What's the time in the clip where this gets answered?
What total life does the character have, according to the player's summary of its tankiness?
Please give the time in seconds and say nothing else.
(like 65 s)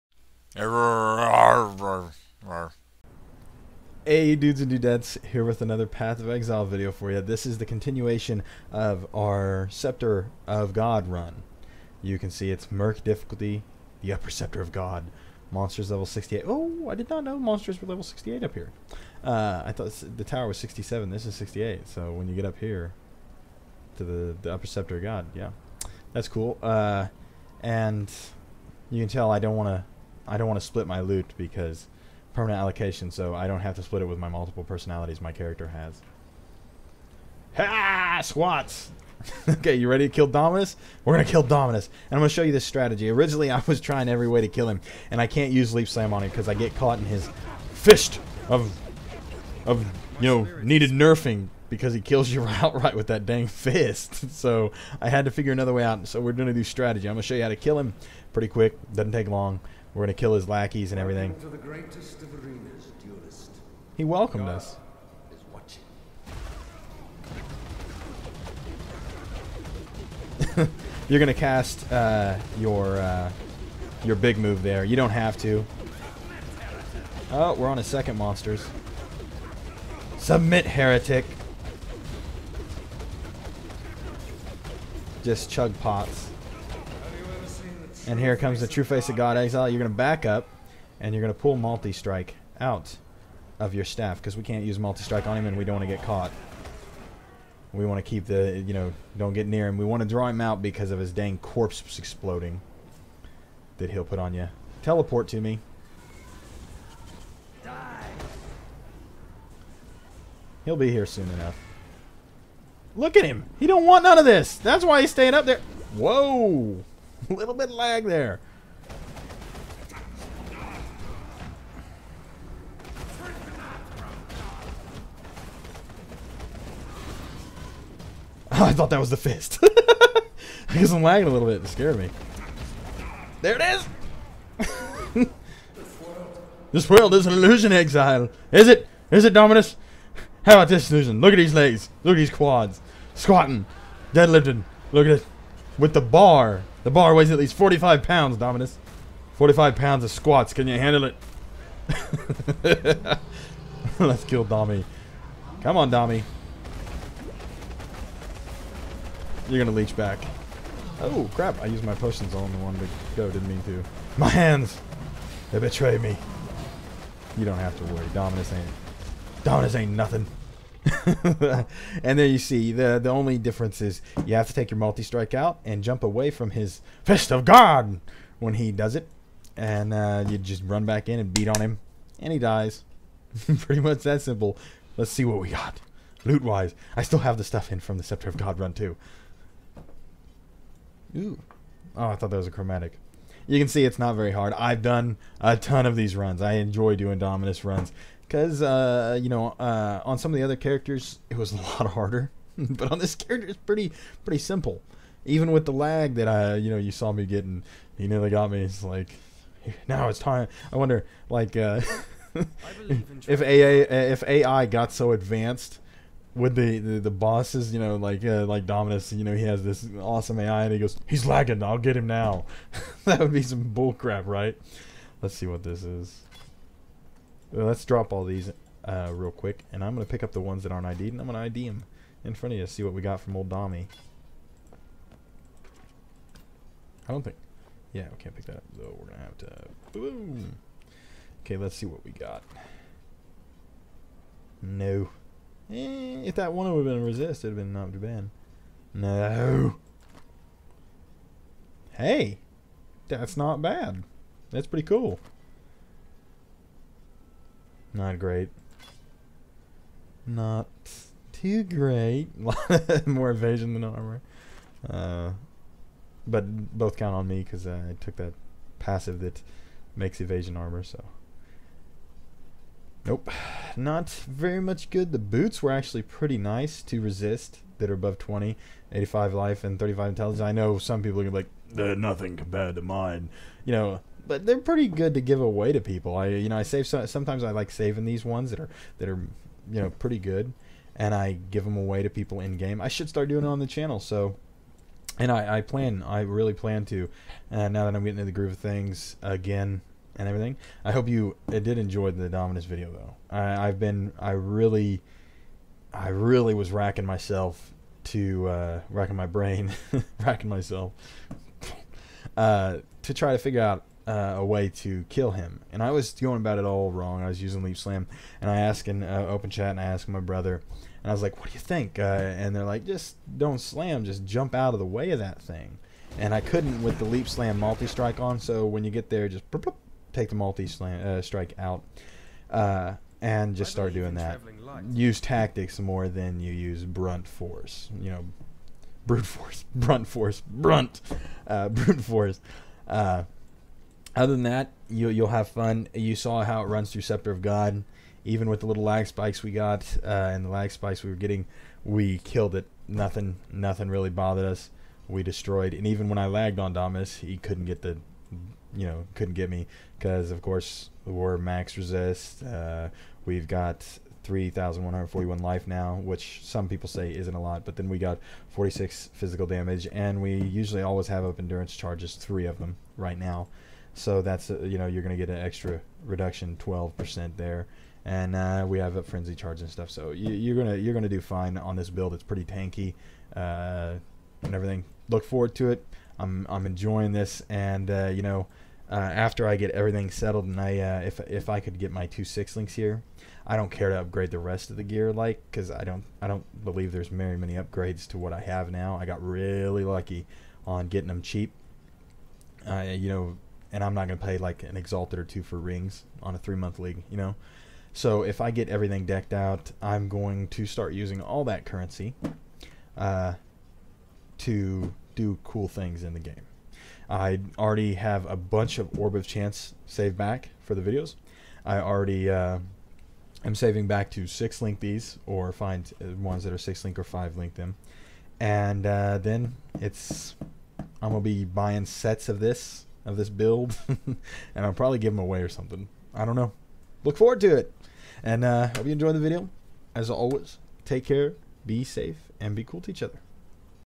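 364 s.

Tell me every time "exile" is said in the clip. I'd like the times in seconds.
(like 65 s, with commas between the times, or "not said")
6 s, 89 s, 137 s.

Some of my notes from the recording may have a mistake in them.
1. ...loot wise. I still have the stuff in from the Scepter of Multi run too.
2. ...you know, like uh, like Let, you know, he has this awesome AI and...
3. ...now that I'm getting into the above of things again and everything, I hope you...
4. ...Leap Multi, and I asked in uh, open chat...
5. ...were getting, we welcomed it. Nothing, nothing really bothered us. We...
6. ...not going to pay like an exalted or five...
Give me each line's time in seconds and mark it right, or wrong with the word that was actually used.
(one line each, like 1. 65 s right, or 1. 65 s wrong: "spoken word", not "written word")
1. 186 s wrong: "God", not "Multi"
2. 217 s wrong: "Dominus", not "Let"
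3. 297 s wrong: "groove", not "above"
4. 317 s wrong: "Slam", not "Multi"
5. 351 s wrong: "killed", not "welcomed"
6. 403 s wrong: "two", not "five".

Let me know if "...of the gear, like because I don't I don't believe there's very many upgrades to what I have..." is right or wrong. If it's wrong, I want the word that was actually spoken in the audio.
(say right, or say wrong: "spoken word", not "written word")
right.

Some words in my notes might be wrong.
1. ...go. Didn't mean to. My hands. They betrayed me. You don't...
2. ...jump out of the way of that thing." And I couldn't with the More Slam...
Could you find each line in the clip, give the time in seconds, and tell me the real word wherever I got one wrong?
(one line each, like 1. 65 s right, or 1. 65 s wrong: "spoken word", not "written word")
1. 163 s right
2. 324 s wrong: "Leap", not "More".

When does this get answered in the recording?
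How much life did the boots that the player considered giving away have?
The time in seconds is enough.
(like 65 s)
278 s.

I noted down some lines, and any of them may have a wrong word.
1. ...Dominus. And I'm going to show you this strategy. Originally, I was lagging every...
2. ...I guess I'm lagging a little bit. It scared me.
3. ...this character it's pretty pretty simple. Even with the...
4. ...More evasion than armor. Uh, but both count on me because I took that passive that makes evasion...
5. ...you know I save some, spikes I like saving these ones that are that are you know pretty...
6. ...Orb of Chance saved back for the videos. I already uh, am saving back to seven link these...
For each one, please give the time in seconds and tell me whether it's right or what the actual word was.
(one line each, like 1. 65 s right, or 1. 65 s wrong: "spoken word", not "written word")
1. 41 s wrong: "trying", not "lagging"
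2. 129 s right
3. 202 s right
4. 263 s right
5. 286 s wrong: "sometimes", not "spikes"
6. 418 s wrong: "six", not "seven".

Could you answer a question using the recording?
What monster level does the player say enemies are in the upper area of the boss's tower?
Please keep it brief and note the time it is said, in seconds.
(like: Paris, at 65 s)
68, at 15 s.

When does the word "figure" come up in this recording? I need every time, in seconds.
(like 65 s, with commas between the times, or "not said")
55 s, 313 s.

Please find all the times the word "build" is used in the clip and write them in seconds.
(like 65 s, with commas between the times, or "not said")
381 s, 433 s.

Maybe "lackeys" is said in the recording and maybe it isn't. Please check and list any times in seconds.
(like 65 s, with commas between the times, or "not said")
60 s.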